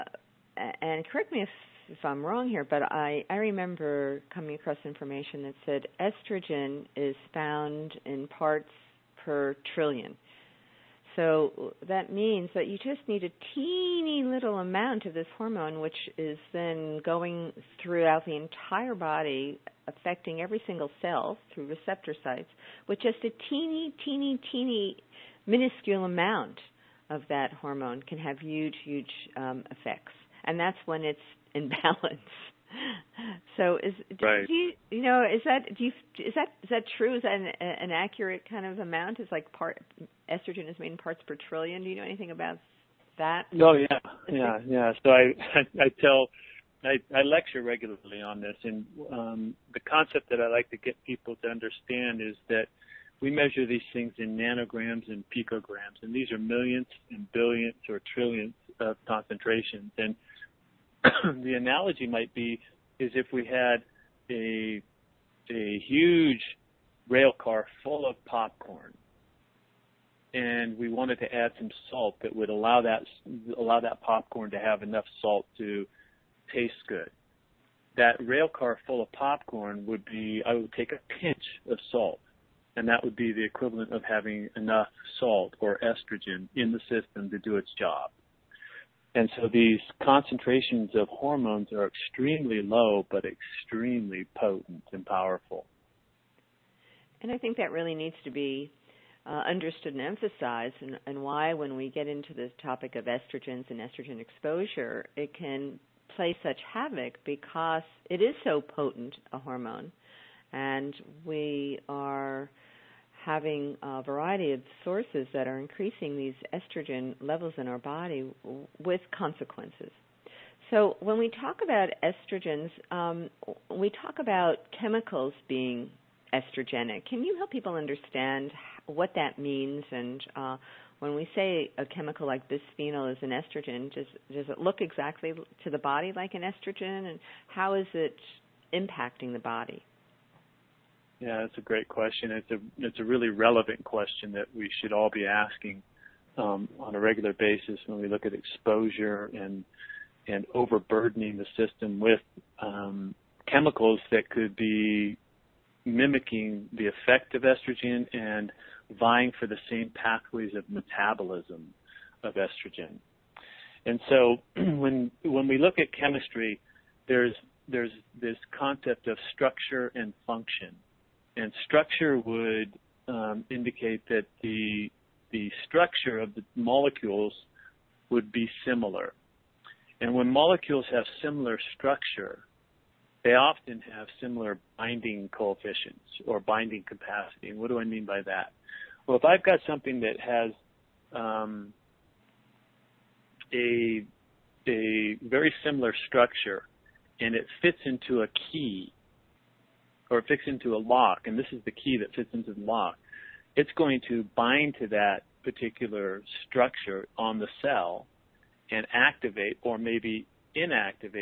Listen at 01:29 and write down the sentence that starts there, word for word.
And so these concentrations of hormones are extremely low, but extremely potent and powerful.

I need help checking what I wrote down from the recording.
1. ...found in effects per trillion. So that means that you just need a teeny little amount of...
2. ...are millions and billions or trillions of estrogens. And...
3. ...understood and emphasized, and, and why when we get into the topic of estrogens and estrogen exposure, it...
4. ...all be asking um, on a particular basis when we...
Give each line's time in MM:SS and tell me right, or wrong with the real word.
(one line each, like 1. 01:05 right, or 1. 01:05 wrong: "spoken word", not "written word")
1. 00:07 wrong: "parts", not "effects"
2. 00:56 wrong: "concentrations", not "estrogens"
3. 01:39 right
4. 02:24 wrong: "regular", not "particular".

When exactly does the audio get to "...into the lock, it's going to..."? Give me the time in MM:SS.
03:22.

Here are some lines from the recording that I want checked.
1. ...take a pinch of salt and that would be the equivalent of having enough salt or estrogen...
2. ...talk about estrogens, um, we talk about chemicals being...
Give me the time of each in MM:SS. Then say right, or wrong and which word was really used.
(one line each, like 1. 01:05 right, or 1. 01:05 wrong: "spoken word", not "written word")
1. 01:20 right
2. 02:01 right.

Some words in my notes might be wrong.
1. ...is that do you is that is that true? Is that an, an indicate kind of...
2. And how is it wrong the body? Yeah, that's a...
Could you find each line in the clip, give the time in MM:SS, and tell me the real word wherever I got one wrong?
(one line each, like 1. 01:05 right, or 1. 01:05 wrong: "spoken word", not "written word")
1. 00:35 wrong: "accurate", not "indicate"
2. 02:17 wrong: "impacting", not "wrong".